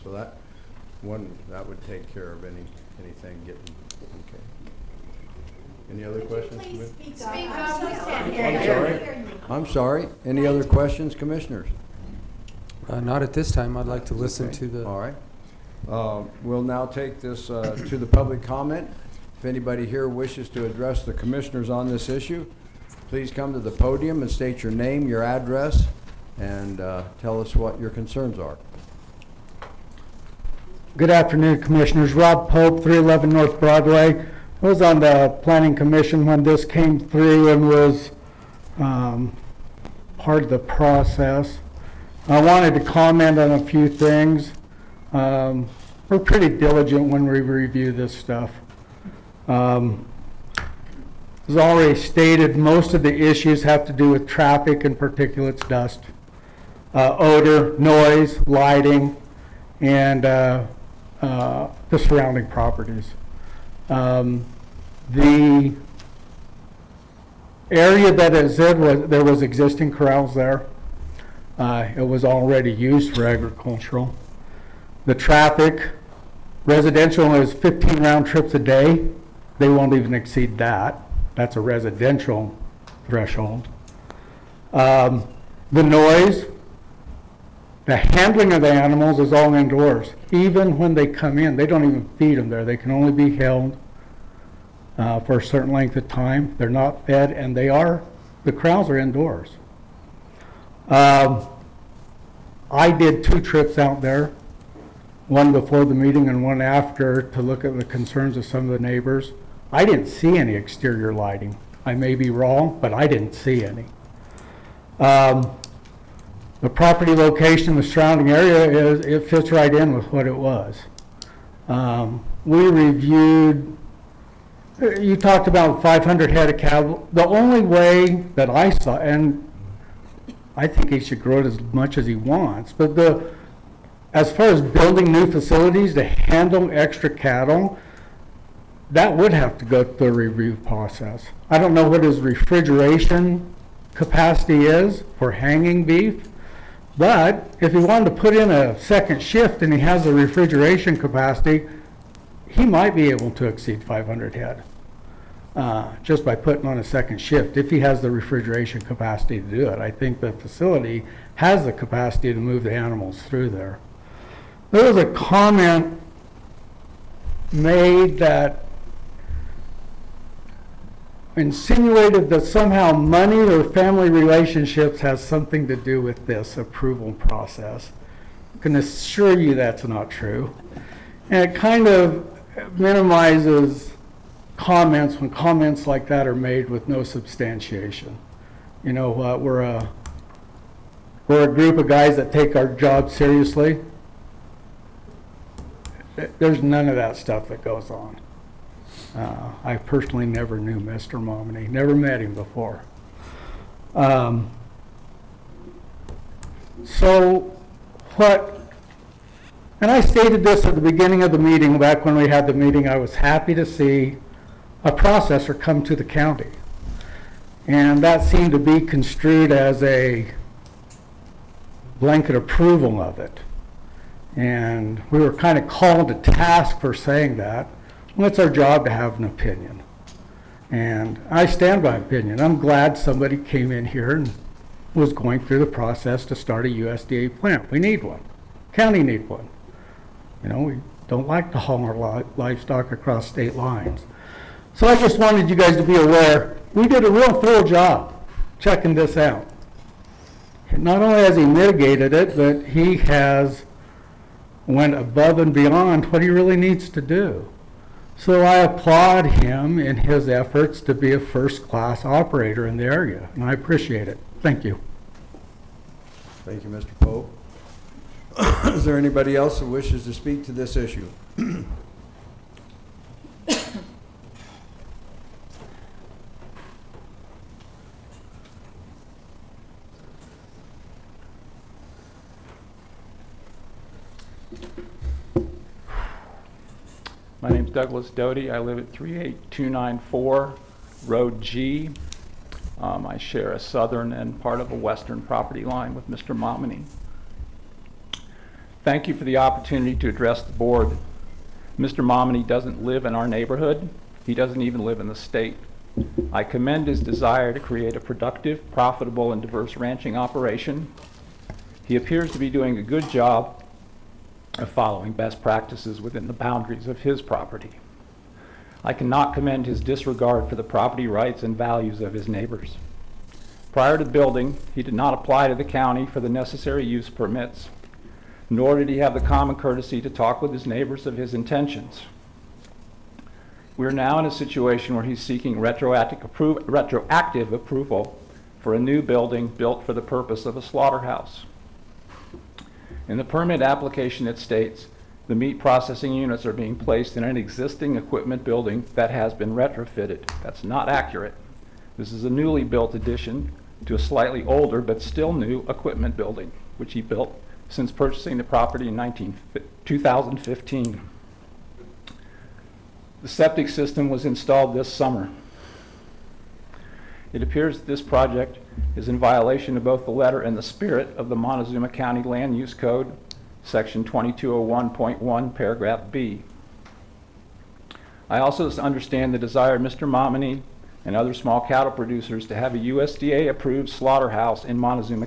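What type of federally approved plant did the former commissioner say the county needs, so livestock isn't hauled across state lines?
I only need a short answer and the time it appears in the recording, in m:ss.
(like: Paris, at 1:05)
USDA plant, at 3:56.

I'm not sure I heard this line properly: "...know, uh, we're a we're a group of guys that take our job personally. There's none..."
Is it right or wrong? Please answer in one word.
wrong.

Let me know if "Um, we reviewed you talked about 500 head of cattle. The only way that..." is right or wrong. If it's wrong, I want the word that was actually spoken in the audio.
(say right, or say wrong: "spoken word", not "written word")
right.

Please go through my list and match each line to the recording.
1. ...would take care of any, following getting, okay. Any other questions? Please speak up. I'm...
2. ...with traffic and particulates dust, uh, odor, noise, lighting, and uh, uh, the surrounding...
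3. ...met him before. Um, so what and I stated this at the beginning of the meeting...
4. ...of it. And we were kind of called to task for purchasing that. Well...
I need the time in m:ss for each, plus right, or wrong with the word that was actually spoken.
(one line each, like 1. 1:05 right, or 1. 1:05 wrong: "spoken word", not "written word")
1. 0:01 wrong: "anything", not "following"
2. 0:54 right
3. 3:21 right
4. 3:43 wrong: "saying", not "purchasing".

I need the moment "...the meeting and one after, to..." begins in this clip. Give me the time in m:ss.
1:45.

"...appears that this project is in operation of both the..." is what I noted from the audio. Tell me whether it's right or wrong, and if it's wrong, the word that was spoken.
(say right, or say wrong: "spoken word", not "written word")
wrong: "violation", not "operation".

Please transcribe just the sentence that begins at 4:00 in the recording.
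You know, we don't like to haul our livestock across state lines.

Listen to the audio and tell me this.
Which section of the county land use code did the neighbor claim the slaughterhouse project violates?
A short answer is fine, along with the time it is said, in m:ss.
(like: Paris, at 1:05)
Section 2201.1, at 6:13.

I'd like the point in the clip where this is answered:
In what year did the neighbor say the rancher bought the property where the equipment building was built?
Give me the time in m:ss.
5:59.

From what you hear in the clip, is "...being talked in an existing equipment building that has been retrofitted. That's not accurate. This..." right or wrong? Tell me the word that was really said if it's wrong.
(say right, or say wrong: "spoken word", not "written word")
wrong: "placed", not "talked".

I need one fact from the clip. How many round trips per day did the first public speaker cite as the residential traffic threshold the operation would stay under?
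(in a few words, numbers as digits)
15.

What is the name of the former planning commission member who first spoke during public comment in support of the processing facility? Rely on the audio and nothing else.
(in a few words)
Rob Pope.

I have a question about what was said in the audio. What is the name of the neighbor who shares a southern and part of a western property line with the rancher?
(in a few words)
Douglas Doty.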